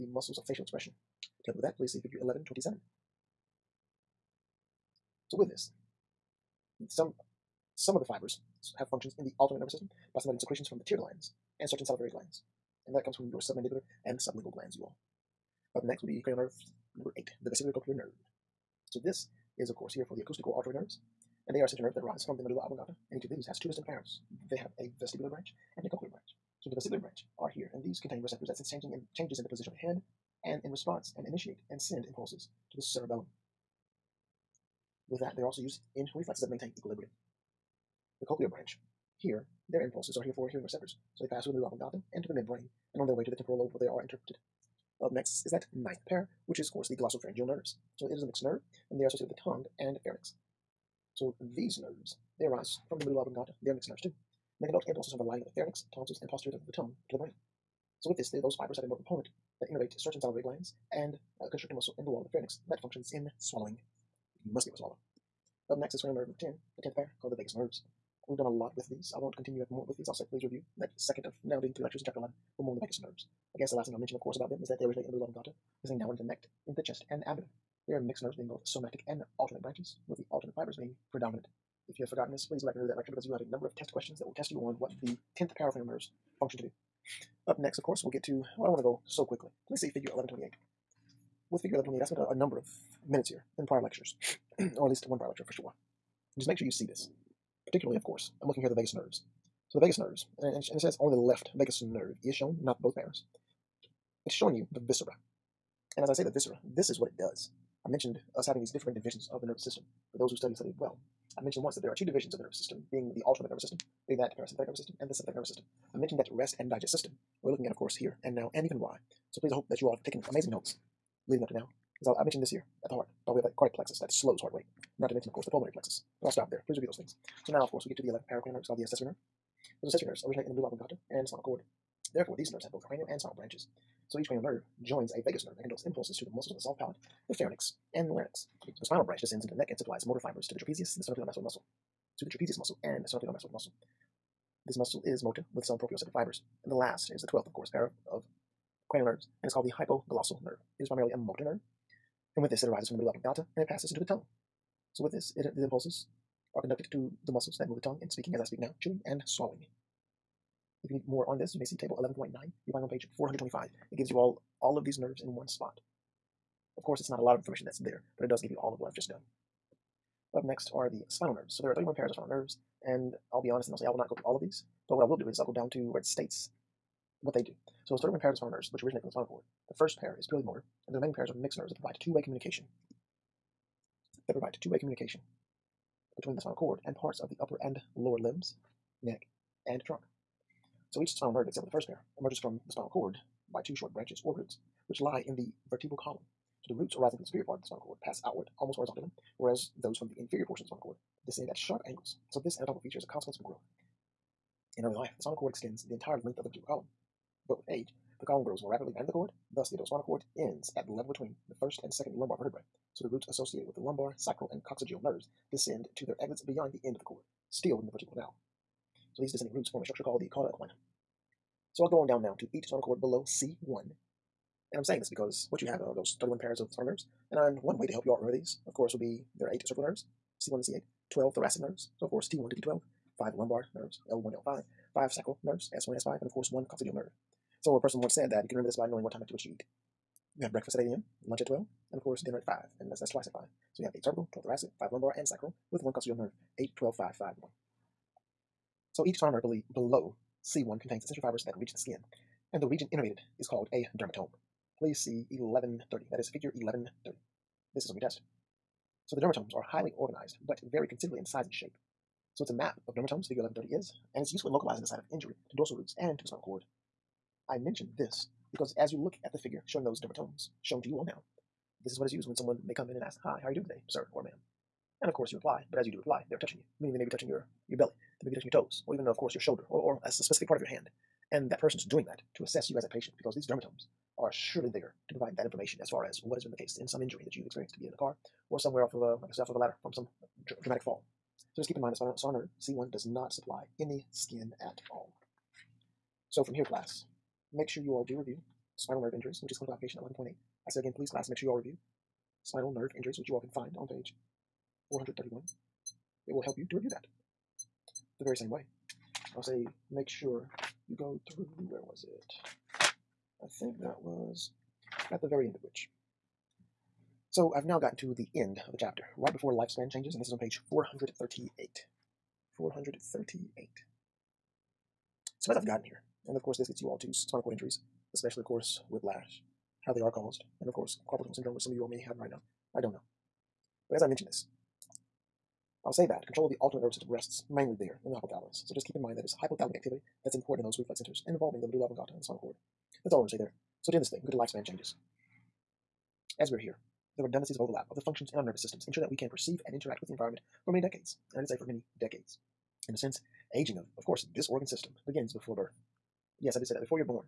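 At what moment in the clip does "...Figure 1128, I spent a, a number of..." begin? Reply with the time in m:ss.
1:31.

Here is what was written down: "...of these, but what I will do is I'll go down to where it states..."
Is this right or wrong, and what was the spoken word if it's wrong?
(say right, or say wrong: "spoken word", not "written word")
right.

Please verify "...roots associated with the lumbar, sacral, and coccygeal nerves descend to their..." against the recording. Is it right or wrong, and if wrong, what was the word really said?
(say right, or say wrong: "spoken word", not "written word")
right.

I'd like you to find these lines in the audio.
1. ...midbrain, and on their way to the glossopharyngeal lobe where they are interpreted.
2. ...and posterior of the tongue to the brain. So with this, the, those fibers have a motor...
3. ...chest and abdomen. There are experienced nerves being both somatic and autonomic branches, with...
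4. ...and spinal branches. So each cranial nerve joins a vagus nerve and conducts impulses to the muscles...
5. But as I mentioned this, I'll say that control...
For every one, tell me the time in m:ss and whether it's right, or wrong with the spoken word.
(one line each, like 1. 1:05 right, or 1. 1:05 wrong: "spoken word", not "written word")
1. 0:42 wrong: "temporal", not "glossopharyngeal"
2. 0:56 right
3. 1:16 wrong: "mixed", not "experienced"
4. 2:13 right
5. 5:33 right.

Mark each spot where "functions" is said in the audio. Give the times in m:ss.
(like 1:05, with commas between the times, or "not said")
0:08, 1:02, 1:26, 5:48.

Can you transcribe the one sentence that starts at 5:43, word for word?
So to end this thing, go to lifespan changes.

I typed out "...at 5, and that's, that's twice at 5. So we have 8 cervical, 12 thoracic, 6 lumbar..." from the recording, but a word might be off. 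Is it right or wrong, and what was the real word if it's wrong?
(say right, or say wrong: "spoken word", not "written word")
wrong: "5", not "6".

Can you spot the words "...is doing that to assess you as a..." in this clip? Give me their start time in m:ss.
4:41.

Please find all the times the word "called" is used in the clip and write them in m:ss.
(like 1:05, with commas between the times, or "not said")
1:07, 2:08, 2:29, 3:40, 4:13.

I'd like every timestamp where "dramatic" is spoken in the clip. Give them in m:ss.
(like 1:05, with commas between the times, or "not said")
4:50.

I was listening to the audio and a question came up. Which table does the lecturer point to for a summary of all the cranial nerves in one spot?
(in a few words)
Table 11.9.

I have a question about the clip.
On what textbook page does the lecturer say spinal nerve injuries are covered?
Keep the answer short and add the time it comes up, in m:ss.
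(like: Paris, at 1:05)
431, at 5:04.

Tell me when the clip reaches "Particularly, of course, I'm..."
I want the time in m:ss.
1:37.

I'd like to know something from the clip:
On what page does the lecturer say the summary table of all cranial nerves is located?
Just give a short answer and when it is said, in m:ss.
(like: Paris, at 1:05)
425, at 2:43.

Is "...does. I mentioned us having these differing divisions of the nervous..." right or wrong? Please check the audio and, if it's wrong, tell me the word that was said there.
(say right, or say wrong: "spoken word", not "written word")
right.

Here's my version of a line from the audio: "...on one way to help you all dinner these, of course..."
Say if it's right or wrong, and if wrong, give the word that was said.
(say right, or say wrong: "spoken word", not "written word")
wrong: "remember", not "dinner".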